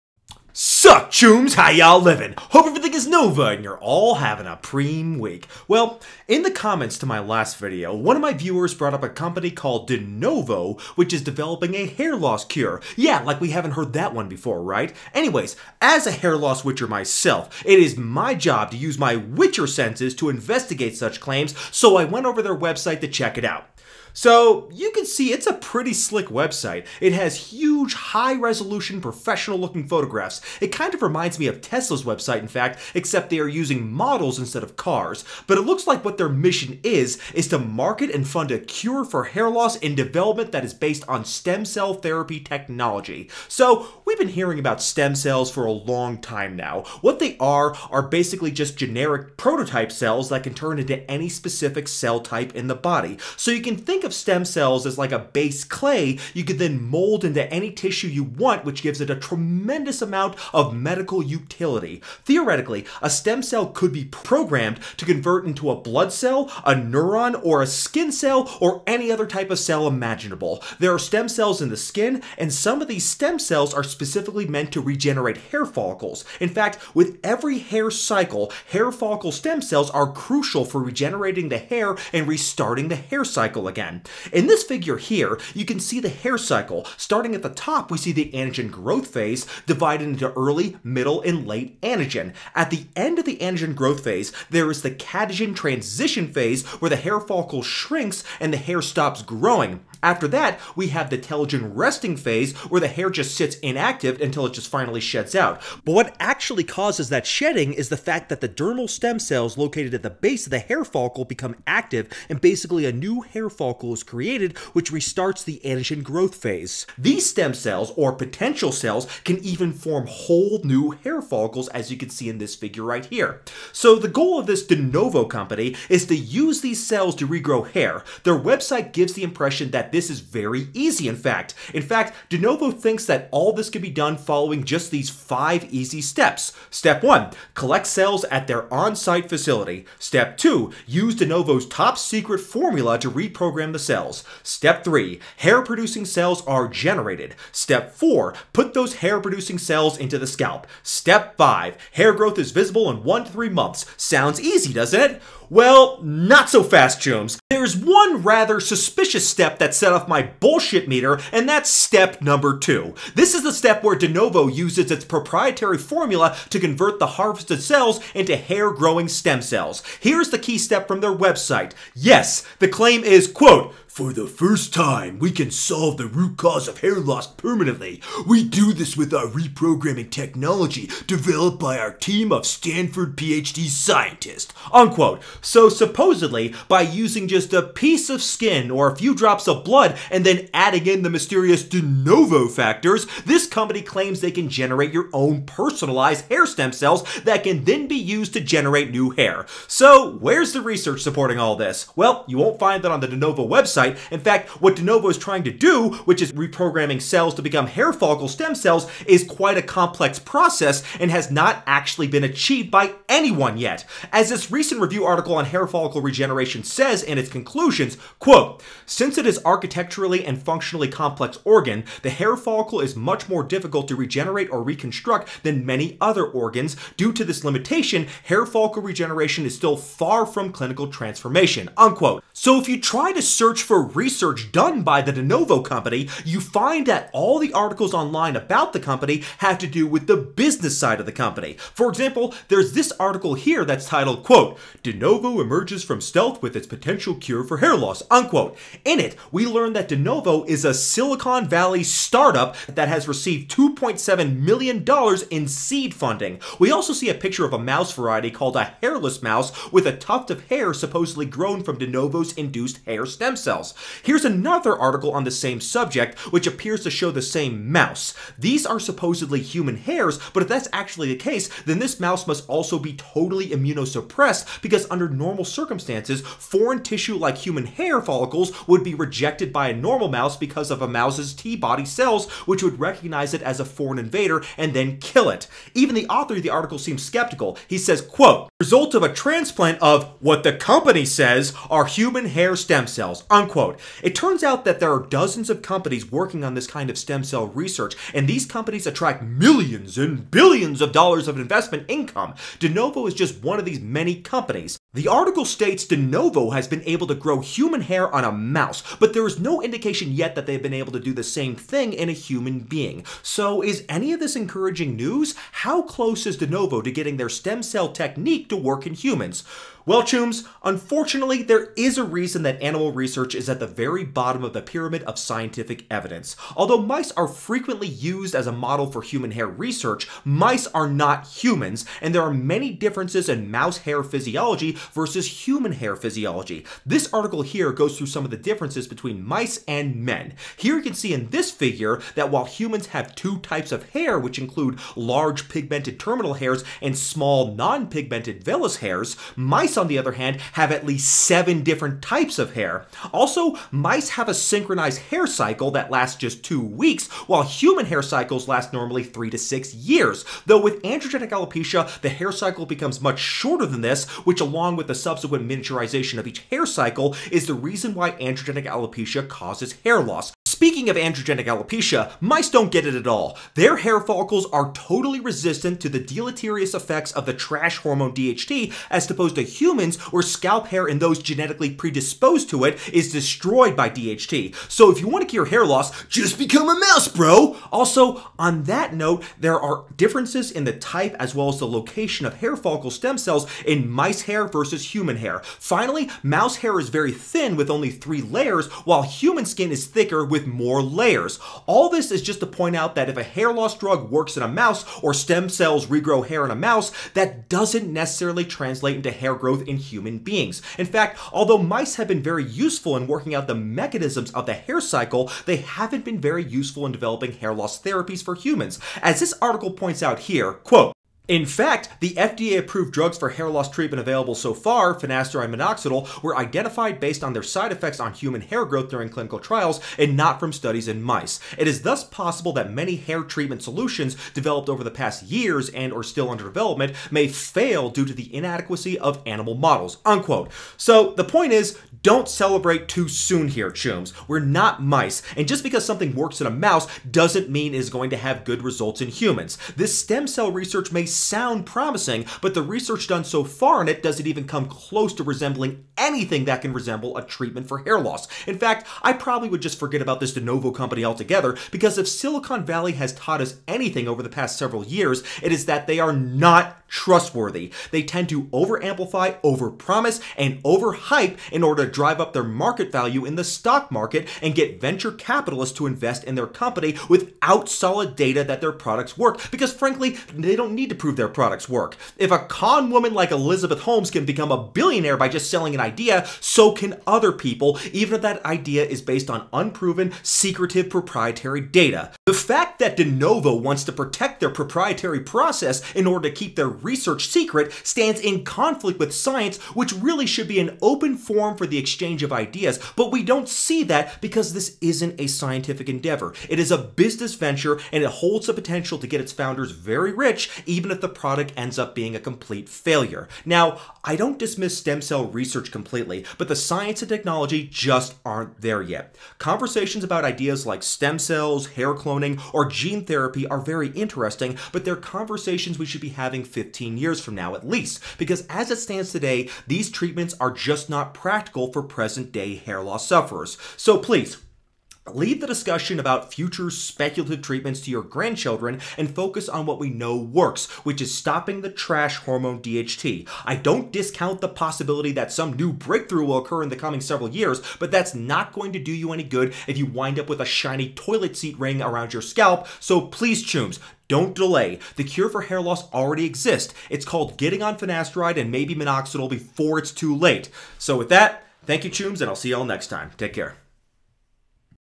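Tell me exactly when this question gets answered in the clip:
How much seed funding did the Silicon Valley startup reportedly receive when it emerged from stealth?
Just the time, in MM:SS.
04:13.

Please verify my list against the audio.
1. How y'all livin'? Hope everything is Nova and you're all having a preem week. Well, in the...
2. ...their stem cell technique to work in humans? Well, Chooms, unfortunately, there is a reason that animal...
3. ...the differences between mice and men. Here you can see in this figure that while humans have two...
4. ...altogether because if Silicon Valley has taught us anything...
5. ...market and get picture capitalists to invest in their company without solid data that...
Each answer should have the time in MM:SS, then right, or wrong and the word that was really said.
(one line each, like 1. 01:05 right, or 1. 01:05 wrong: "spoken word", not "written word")
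1. 00:01 right
2. 05:17 right
3. 05:38 right
4. 07:41 right
5. 07:53 wrong: "venture", not "picture".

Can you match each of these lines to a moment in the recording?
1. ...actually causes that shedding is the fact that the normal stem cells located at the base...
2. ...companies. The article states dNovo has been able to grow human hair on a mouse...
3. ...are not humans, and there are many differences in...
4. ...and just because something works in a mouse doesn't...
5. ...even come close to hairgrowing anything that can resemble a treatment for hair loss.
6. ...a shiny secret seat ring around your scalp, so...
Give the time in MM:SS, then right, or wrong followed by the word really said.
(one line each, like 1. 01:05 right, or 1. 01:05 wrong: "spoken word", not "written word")
1. 01:46 wrong: "dermal", not "normal"
2. 05:04 right
3. 05:30 right
4. 07:25 right
5. 07:34 wrong: "resembling", not "hairgrowing"
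6. 09:10 wrong: "toilet", not "secret".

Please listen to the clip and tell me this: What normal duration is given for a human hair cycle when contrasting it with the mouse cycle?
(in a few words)
3 to 6 years.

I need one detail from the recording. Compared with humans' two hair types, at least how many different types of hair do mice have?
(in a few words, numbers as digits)
7.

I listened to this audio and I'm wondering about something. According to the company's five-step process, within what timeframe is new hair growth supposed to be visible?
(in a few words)
1 to 3 months.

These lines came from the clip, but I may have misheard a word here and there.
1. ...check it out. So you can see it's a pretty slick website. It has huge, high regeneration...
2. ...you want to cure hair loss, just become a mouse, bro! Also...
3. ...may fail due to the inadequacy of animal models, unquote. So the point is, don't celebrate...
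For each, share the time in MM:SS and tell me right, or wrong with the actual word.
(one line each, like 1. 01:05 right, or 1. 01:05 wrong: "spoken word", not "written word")
1. 00:23 wrong: "resolution", not "regeneration"
2. 06:24 right
3. 07:17 right.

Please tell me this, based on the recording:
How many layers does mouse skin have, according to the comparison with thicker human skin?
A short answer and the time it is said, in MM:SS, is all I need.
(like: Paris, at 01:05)
3, at 06:37.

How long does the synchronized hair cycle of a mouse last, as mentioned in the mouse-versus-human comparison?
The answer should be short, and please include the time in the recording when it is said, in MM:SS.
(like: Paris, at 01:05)
2 weeks, at 05:56.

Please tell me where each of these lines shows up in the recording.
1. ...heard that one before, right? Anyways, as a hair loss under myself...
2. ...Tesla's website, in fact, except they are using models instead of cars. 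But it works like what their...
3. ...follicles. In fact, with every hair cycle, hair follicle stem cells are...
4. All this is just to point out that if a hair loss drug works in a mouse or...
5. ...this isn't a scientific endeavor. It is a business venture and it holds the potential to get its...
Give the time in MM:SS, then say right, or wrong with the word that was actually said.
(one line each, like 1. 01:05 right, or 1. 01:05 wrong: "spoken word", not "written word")
1. 00:13 wrong: "witcher", not "under"
2. 00:31 wrong: "looks", not "works"
3. 01:15 right
4. 06:41 right
5. 08:24 right.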